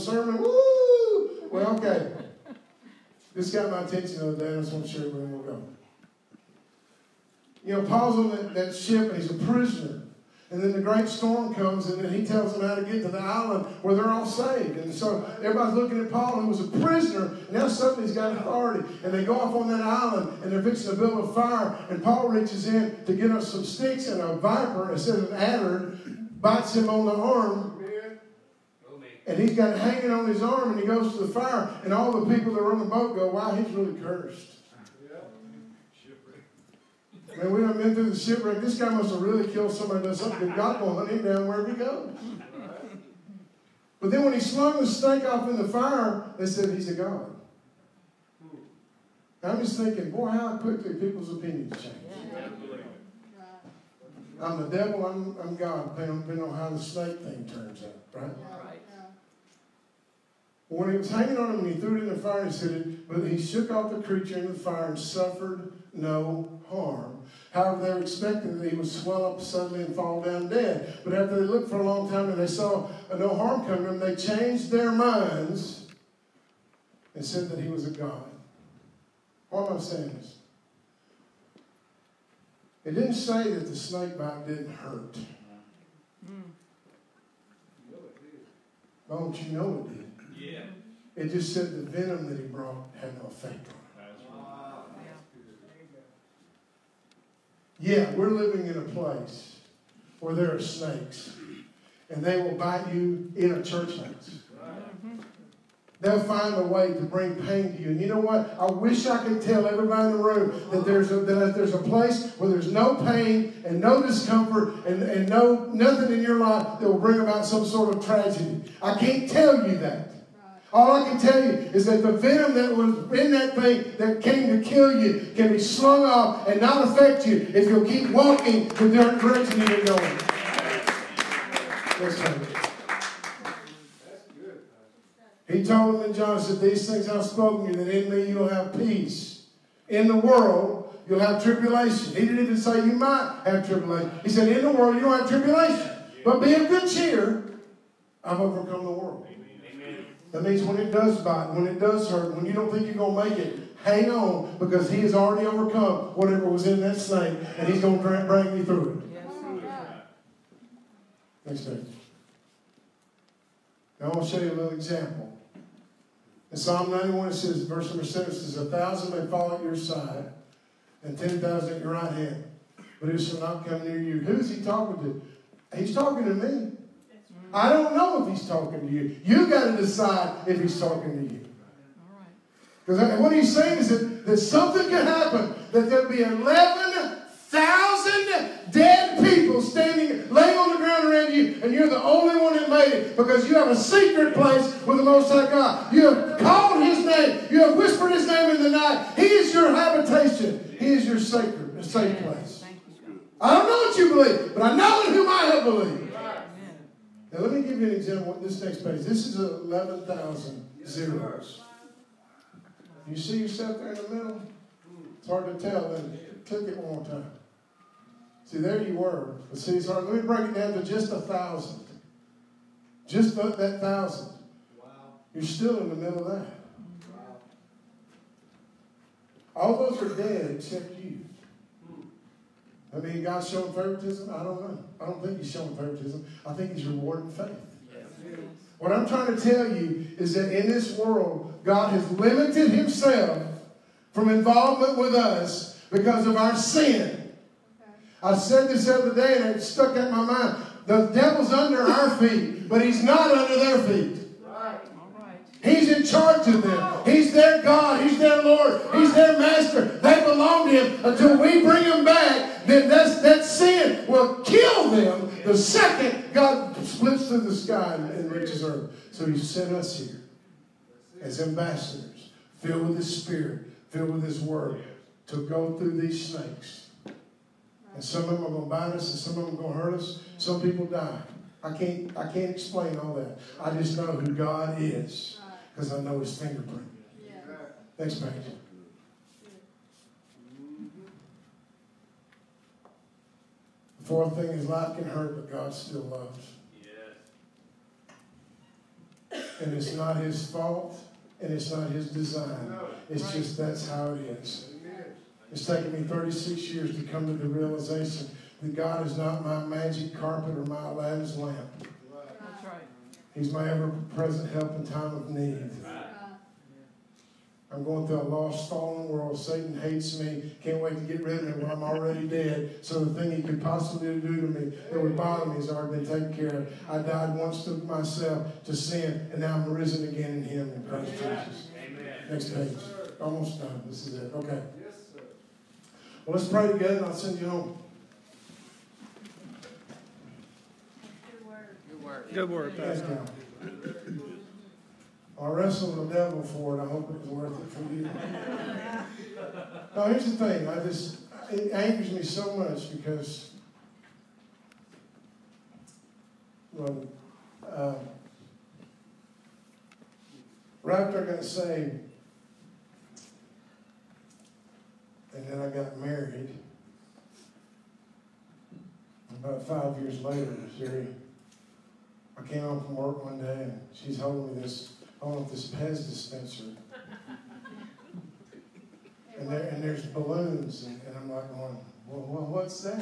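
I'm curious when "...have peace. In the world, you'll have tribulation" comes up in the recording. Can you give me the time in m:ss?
2:18.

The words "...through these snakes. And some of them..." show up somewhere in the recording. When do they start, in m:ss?
4:35.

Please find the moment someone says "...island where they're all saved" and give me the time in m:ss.
0:13.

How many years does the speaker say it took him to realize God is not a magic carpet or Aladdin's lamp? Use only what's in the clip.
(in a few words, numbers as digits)
36.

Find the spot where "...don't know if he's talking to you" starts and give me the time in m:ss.
2:57.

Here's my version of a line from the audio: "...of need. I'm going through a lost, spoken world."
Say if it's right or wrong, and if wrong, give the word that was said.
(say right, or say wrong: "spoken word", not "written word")
wrong: "fallen", not "spoken".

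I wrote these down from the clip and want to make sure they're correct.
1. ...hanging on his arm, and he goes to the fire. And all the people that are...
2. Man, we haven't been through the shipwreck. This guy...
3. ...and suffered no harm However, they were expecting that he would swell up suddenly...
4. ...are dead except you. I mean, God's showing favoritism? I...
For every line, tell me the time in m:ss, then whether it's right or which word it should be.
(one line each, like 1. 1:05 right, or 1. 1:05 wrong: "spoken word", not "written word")
1. 0:29 right
2. 0:37 right
3. 1:04 right
4. 3:50 right.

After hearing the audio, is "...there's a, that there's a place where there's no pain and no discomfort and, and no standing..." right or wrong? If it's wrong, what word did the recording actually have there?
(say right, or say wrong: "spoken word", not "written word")
wrong: "nothing", not "standing".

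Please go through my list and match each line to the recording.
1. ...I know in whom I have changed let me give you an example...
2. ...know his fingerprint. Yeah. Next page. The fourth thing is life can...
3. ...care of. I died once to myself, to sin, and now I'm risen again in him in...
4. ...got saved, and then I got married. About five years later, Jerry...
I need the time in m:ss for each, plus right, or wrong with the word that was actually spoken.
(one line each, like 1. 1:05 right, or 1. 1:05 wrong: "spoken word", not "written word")
1. 3:24 wrong: "believed", not "changed"
2. 4:46 right
3. 5:26 right
4. 6:01 right.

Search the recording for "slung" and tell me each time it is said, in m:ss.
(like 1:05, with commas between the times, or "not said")
0:44, 2:05.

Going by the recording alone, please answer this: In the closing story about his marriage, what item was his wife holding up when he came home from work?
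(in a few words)
Pez dispenser.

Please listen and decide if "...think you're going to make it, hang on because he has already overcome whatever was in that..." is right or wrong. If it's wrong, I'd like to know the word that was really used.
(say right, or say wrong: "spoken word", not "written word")
right.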